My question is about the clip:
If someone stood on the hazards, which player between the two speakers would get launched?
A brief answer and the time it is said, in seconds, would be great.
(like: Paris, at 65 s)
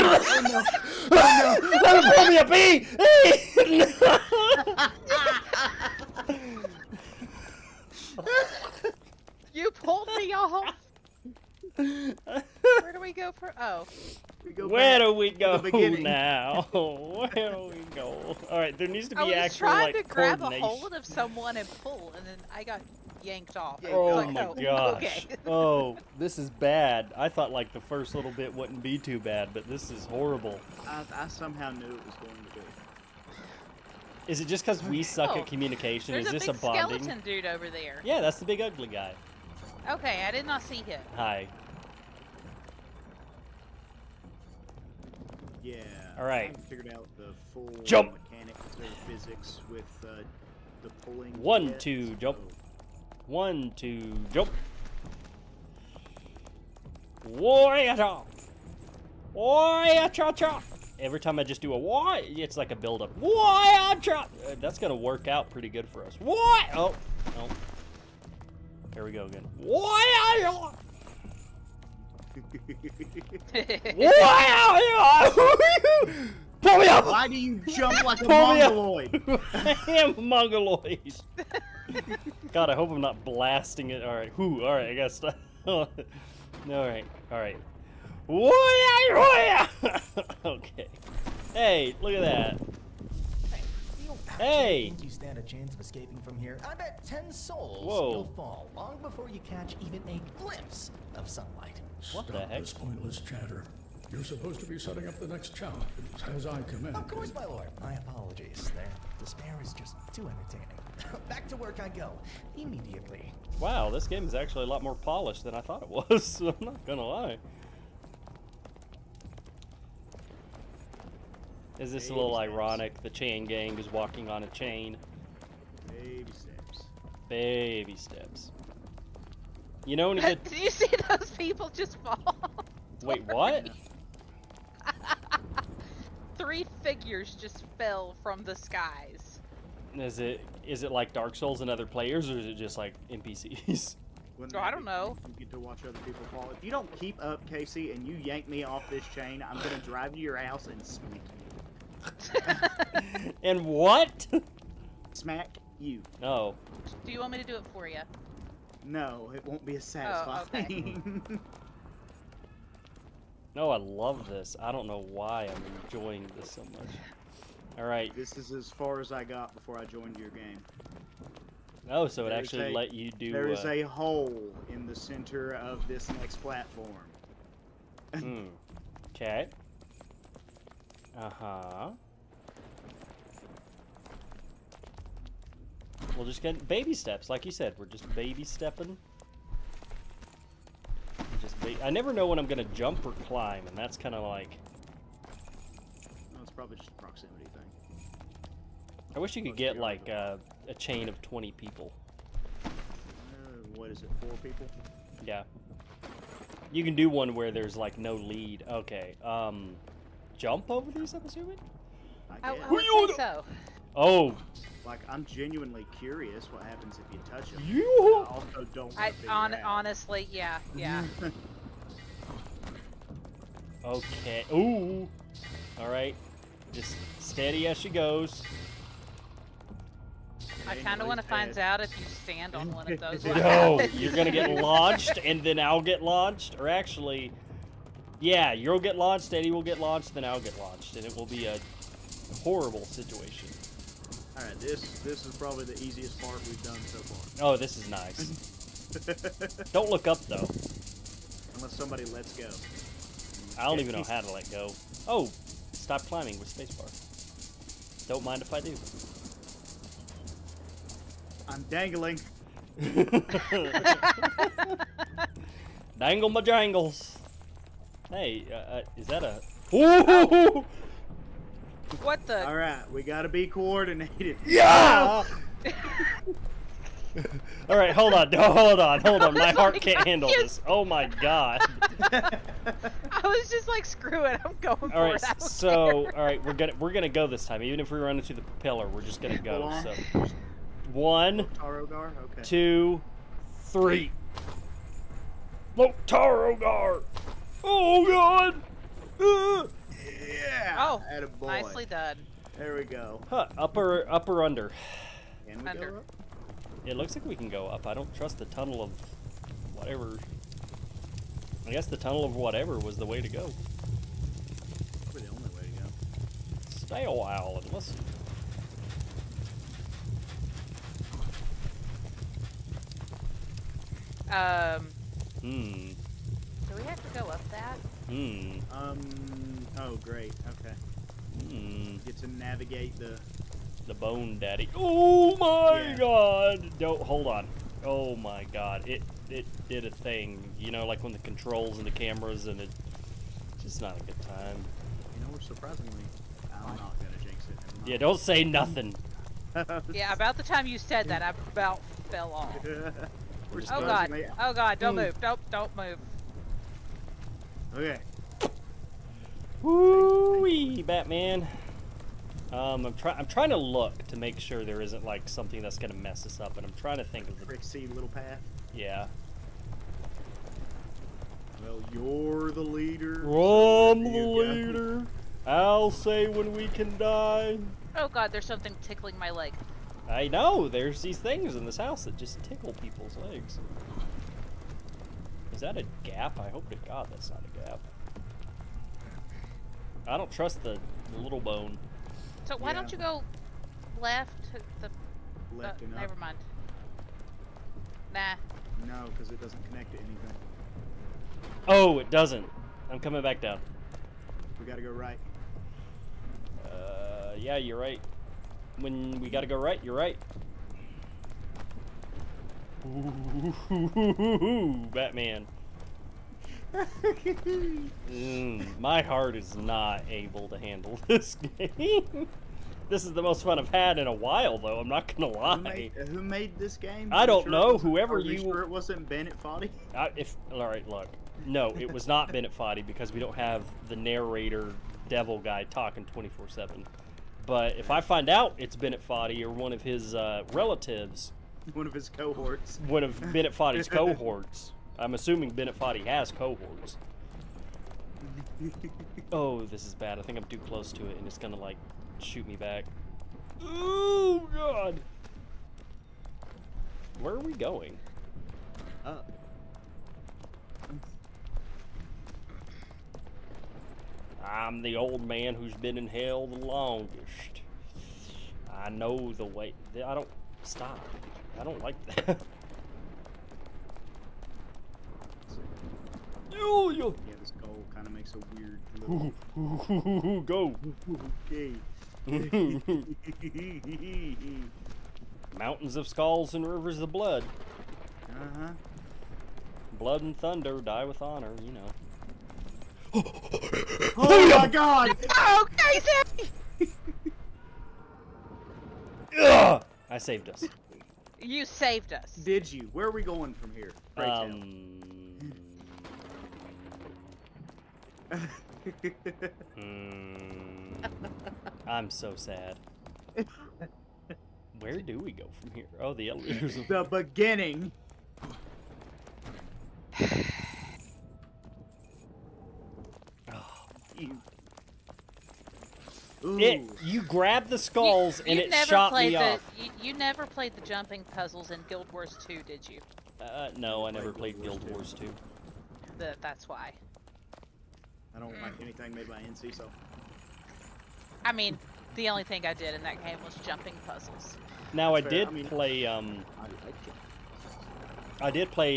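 Eddie, at 239 s.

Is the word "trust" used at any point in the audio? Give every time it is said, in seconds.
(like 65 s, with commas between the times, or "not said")
308 s, 390 s.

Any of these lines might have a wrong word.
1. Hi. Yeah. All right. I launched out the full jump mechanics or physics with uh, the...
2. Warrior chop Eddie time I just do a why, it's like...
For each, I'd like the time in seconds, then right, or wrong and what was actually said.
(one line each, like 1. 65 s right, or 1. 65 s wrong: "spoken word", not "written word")
1. 41 s wrong: "figured", not "launched"
2. 59 s wrong: "Every", not "Eddie".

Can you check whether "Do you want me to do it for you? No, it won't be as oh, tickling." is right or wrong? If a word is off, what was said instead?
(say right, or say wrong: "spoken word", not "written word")
wrong: "satisfying", not "tickling".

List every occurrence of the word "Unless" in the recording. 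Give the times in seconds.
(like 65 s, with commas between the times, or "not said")
251 s.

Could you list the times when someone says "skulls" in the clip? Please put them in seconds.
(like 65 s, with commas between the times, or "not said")
486 s, 527 s.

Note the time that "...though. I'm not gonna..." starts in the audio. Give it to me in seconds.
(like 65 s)
424 s.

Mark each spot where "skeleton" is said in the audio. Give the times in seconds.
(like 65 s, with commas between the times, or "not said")
37 s.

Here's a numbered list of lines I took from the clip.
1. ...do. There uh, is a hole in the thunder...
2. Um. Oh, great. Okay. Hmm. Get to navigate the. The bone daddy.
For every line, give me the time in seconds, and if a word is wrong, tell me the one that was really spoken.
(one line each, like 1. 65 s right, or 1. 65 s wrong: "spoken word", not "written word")
1. 173 s wrong: "center", not "thunder"
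2. 328 s right.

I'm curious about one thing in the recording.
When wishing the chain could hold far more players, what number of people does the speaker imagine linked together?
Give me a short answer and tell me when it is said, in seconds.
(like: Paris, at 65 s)
20, at 201 s.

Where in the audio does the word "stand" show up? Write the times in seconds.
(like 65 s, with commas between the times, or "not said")
95 s, 232 s.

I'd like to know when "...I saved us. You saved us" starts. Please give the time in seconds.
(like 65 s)
500 s.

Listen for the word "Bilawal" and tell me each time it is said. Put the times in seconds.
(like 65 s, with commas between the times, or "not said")
not said.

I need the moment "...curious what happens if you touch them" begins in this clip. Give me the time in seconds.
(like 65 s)
215 s.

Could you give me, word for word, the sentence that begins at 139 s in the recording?
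Is it is it like Dark Souls and other players, or is it just like NPCs?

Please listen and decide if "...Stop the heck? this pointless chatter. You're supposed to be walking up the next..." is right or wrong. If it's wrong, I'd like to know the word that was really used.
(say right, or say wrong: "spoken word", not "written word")
wrong: "setting", not "walking".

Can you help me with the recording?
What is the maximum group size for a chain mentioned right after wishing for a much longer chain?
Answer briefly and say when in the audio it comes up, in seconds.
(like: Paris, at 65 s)
Four, at 204 s.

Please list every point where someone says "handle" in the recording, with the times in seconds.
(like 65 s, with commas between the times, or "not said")
280 s, 420 s.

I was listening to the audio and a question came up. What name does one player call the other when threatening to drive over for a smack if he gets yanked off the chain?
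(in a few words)
Casey.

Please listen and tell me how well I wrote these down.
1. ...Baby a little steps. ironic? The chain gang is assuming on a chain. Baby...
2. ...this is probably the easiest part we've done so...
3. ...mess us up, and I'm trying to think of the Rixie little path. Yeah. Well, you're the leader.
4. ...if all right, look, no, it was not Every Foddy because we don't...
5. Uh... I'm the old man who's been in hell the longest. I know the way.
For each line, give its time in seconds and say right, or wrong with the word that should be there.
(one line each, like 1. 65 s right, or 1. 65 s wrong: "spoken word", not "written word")
1. 122 s wrong: "walking", not "assuming"
2. 244 s right
3. 365 s right
4. 430 s wrong: "Bennett", not "Every"
5. 459 s right.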